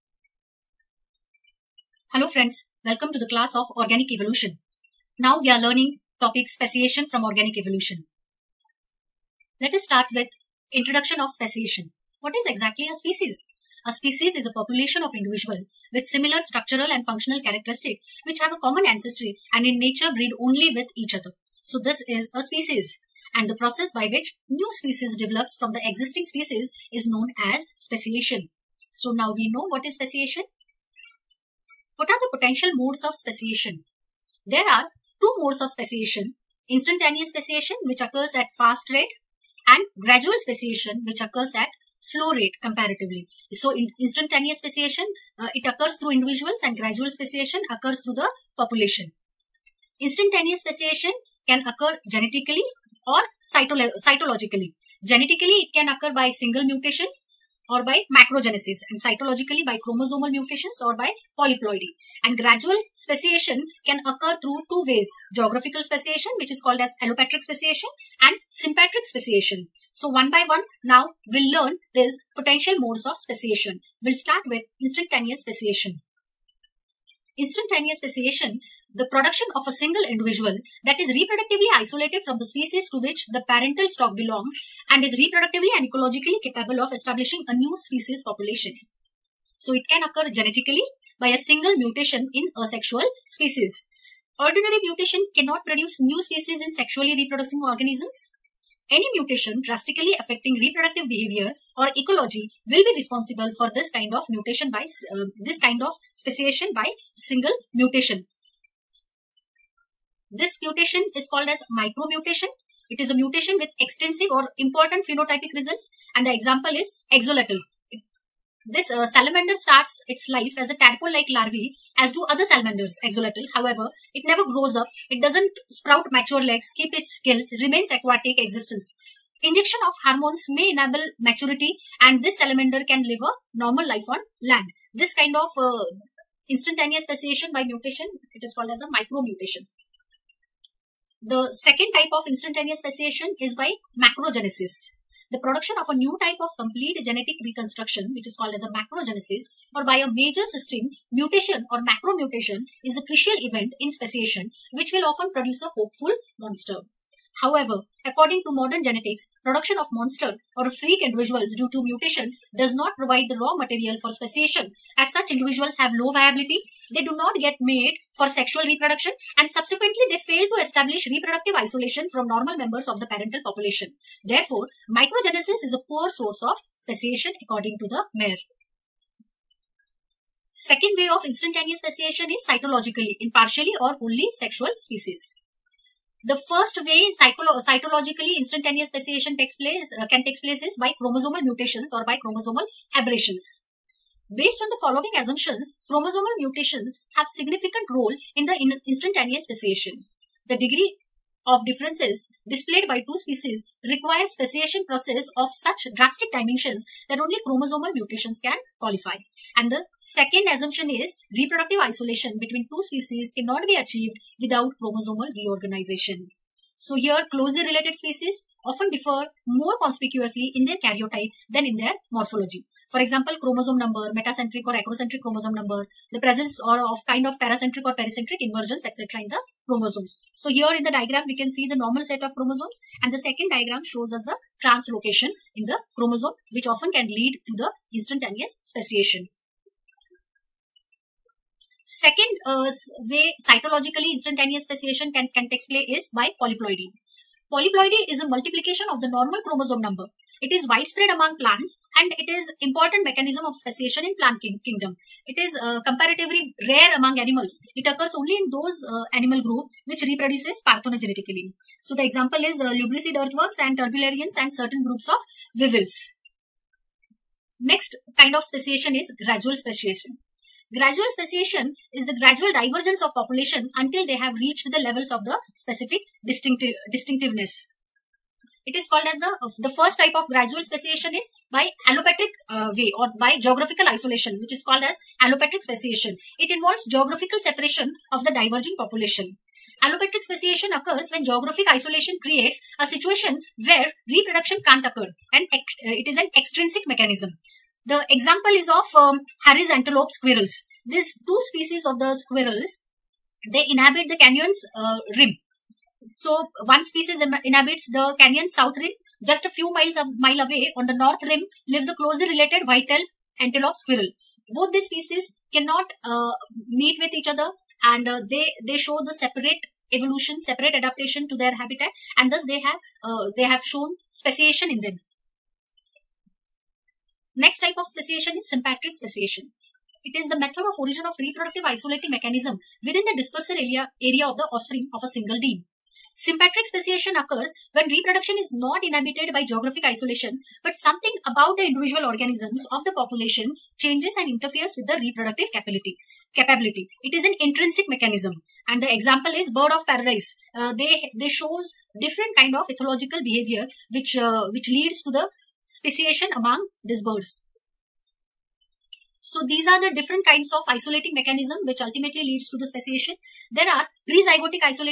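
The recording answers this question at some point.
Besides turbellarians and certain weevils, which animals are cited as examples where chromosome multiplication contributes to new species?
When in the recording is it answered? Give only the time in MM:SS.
04:22.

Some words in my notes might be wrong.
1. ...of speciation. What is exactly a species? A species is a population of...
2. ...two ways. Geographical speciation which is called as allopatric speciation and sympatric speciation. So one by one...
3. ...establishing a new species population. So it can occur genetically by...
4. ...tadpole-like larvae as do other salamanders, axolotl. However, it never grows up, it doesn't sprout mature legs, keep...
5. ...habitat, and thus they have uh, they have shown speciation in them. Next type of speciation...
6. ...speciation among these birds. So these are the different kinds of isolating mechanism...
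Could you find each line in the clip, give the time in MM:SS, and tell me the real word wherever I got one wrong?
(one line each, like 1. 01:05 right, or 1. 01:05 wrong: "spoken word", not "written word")
1. 00:11 right
2. 01:04 right
3. 01:26 right
4. 02:00 right
5. 05:21 right
6. 05:55 right.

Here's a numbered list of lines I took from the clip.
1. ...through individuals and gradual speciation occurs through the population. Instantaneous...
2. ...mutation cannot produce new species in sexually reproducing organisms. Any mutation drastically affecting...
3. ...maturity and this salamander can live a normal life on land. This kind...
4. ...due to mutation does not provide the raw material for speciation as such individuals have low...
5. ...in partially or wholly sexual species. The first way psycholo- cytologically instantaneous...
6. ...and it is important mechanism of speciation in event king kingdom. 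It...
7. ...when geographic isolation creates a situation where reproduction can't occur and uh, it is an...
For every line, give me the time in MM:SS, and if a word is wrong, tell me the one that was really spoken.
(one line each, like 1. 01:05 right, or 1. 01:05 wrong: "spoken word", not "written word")
1. 00:45 right
2. 01:34 right
3. 02:11 right
4. 02:41 right
5. 03:03 right
6. 04:11 wrong: "plant", not "event"
7. 04:51 right.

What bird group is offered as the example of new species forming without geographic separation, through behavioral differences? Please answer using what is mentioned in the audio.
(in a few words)
Bird of paradise.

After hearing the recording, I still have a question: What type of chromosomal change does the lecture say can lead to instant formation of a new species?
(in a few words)
Translocation.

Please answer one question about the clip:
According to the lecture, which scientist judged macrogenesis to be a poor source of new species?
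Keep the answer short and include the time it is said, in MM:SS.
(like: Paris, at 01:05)
Mayr, at 02:58.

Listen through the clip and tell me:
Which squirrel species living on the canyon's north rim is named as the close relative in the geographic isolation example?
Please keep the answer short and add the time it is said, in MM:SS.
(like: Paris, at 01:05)
White-tailed antelope squirrel, at 05:12.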